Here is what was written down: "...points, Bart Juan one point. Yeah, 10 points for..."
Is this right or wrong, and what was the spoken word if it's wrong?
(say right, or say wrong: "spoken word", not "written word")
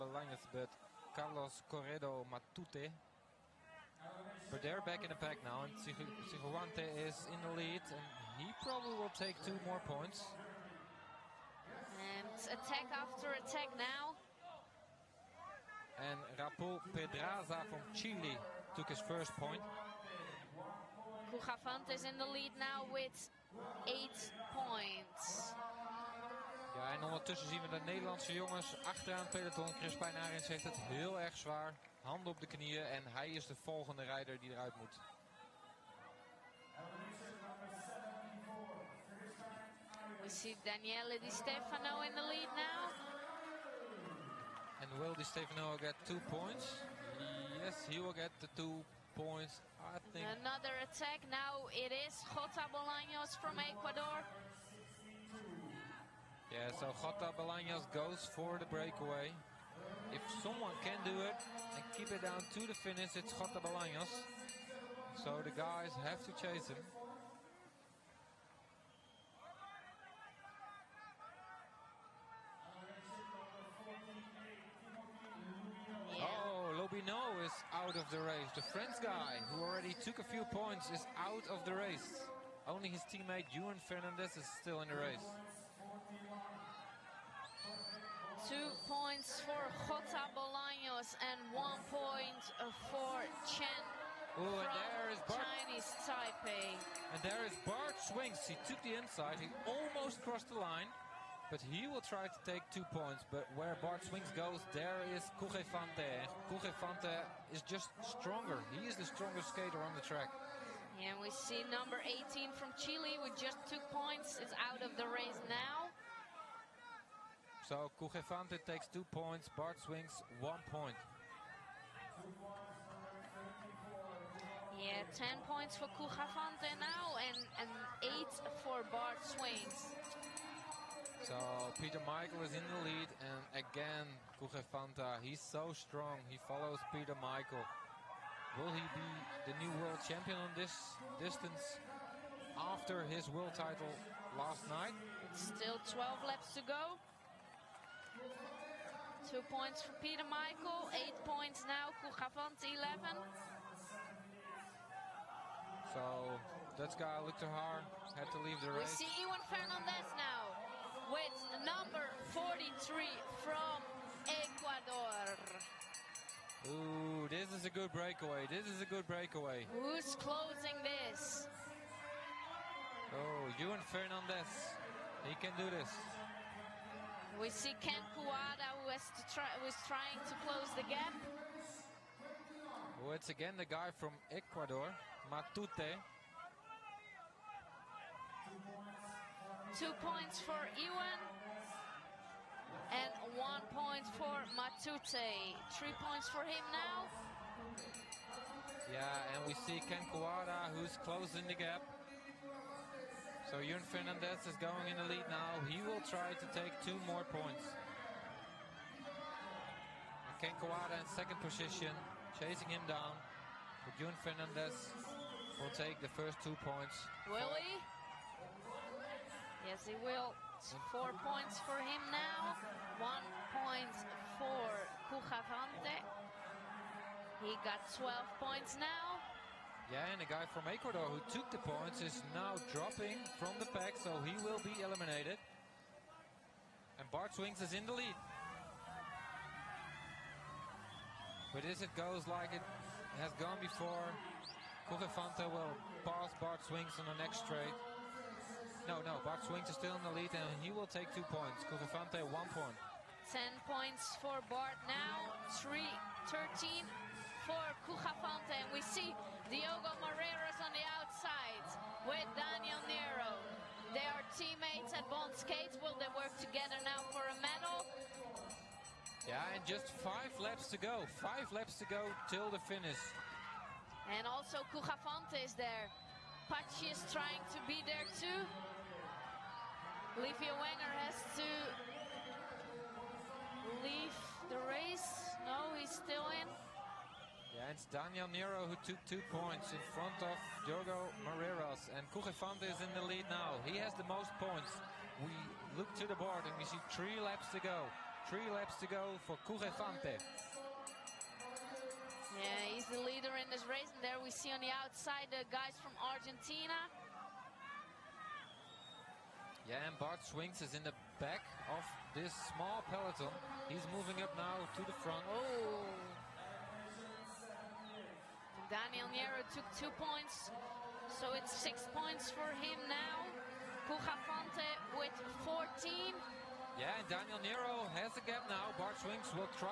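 wrong: "Swings", not "Juan".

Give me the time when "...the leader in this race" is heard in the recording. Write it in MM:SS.
05:02.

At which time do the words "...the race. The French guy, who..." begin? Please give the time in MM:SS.
01:18.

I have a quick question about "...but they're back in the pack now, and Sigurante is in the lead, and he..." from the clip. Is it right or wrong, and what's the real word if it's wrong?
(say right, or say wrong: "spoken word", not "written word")
right.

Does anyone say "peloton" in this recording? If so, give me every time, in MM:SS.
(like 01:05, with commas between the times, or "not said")
00:29, 05:12.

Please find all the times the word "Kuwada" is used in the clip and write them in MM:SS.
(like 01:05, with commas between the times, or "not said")
02:58, 03:20, 03:30.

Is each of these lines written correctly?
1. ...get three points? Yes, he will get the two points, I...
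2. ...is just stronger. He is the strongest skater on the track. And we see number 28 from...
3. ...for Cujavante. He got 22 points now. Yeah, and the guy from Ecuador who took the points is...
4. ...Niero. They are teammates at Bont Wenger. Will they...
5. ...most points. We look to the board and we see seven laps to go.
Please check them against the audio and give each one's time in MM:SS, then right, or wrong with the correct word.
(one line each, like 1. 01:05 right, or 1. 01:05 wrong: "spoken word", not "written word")
1. 00:45 wrong: "two", not "three"
2. 01:47 wrong: "18", not "28"
3. 03:44 wrong: "12", not "22"
4. 04:22 wrong: "Skates", not "Wenger"
5. 04:54 wrong: "three", not "seven".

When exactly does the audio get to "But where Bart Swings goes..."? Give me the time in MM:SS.
01:43.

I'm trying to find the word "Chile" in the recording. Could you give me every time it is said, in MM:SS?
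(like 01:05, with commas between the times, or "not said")
00:17, 01:52.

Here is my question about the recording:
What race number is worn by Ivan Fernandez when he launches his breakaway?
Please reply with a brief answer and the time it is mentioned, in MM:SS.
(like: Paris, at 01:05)
43, at 02:42.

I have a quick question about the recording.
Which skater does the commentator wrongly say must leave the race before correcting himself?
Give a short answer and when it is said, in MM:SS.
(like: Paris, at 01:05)
Livio Wenger, at 04:40.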